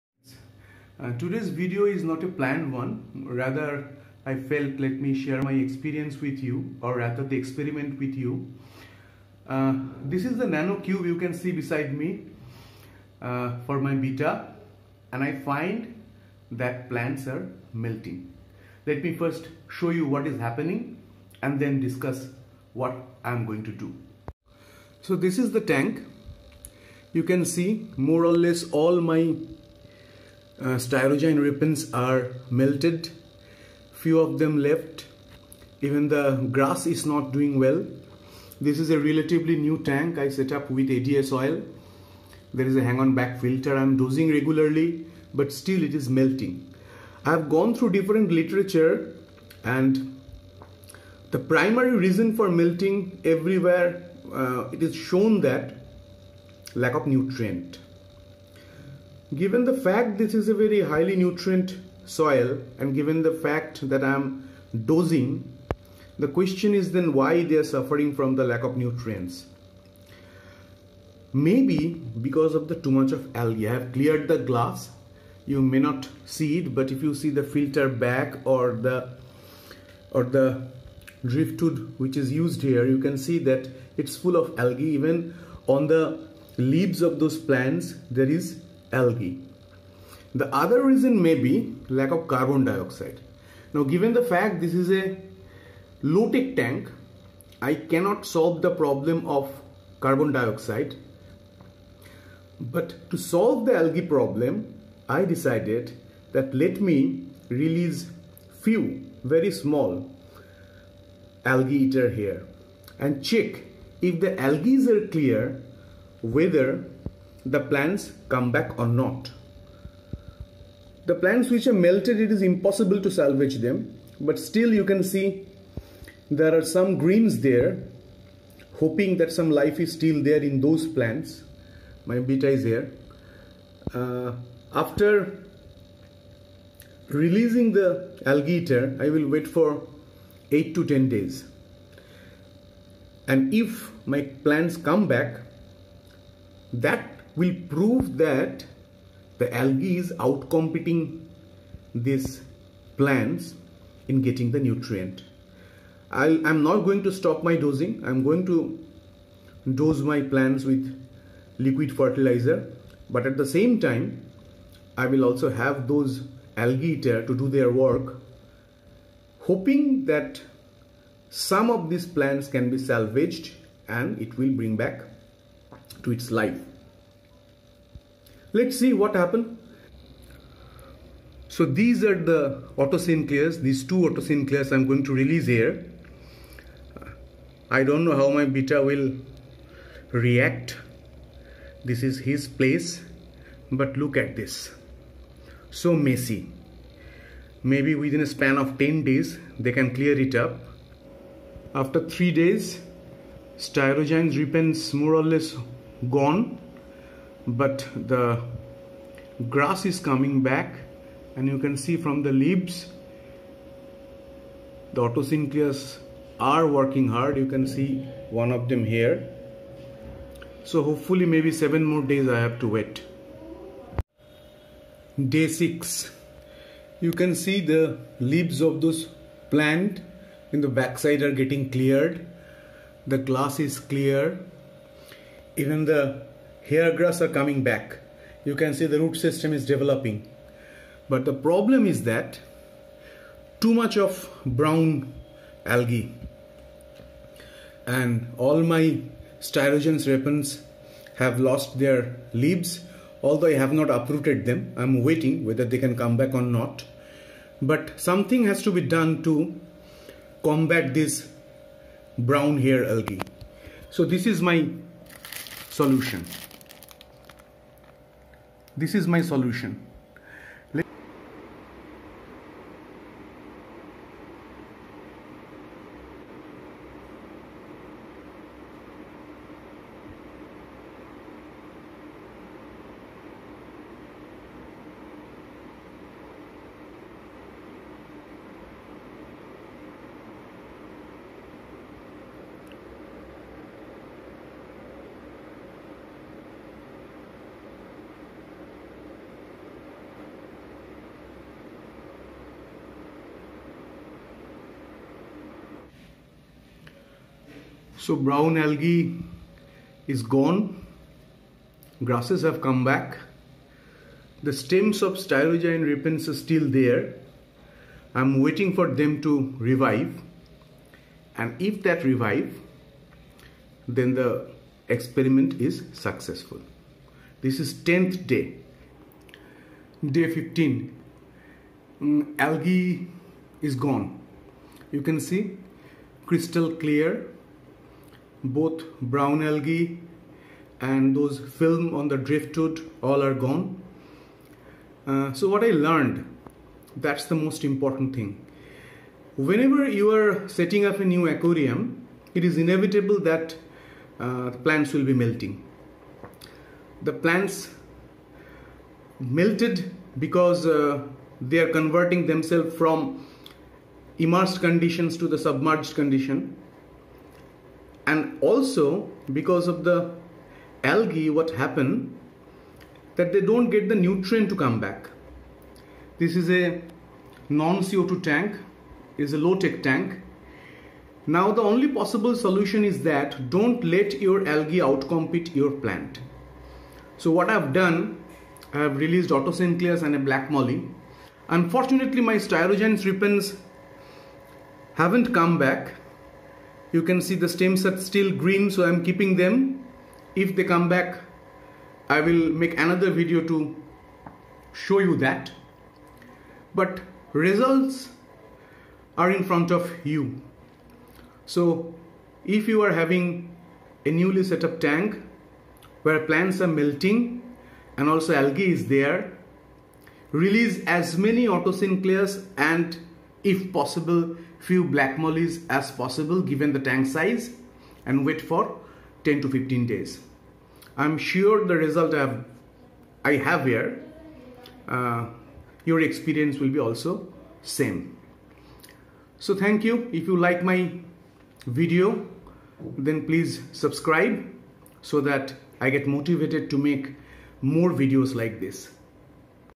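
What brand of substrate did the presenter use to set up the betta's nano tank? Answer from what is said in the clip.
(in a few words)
ADA soil.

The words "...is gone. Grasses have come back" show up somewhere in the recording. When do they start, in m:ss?
5:10.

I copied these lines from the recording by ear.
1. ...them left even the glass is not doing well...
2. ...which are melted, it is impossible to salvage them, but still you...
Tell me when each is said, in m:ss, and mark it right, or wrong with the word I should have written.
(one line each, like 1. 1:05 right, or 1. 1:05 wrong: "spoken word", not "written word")
1. 0:34 wrong: "grass", not "glass"
2. 2:01 right.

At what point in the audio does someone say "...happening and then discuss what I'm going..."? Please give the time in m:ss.
0:20.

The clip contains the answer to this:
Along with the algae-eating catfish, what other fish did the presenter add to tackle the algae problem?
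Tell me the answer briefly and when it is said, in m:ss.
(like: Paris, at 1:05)
black molly, at 6:30.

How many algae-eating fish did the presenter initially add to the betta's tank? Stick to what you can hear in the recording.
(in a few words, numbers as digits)
2.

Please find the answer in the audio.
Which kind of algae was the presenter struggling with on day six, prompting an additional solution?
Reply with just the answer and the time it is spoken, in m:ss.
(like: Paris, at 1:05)
brown hair algae, at 4:22.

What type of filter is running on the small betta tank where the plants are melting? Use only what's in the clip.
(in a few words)
hang on back filter.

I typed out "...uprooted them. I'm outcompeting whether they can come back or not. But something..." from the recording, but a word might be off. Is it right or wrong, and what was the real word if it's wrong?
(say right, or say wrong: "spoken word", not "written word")
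wrong: "waiting", not "outcompeting".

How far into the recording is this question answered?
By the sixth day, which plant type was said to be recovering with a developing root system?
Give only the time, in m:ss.
3:56.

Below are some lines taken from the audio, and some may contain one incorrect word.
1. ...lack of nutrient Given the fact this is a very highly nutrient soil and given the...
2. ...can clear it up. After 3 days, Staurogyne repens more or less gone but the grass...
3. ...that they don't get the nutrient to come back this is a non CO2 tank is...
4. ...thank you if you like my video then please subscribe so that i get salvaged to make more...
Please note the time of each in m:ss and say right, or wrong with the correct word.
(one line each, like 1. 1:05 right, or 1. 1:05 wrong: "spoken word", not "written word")
1. 0:56 right
2. 3:19 right
3. 6:13 right
4. 7:19 wrong: "motivated", not "salvaged".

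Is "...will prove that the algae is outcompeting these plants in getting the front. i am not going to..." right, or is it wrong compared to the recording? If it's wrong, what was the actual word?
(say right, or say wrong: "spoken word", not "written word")
wrong: "nutrient", not "front".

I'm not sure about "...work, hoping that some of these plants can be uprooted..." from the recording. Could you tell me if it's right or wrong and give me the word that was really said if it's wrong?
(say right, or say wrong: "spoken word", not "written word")
wrong: "salvaged", not "uprooted".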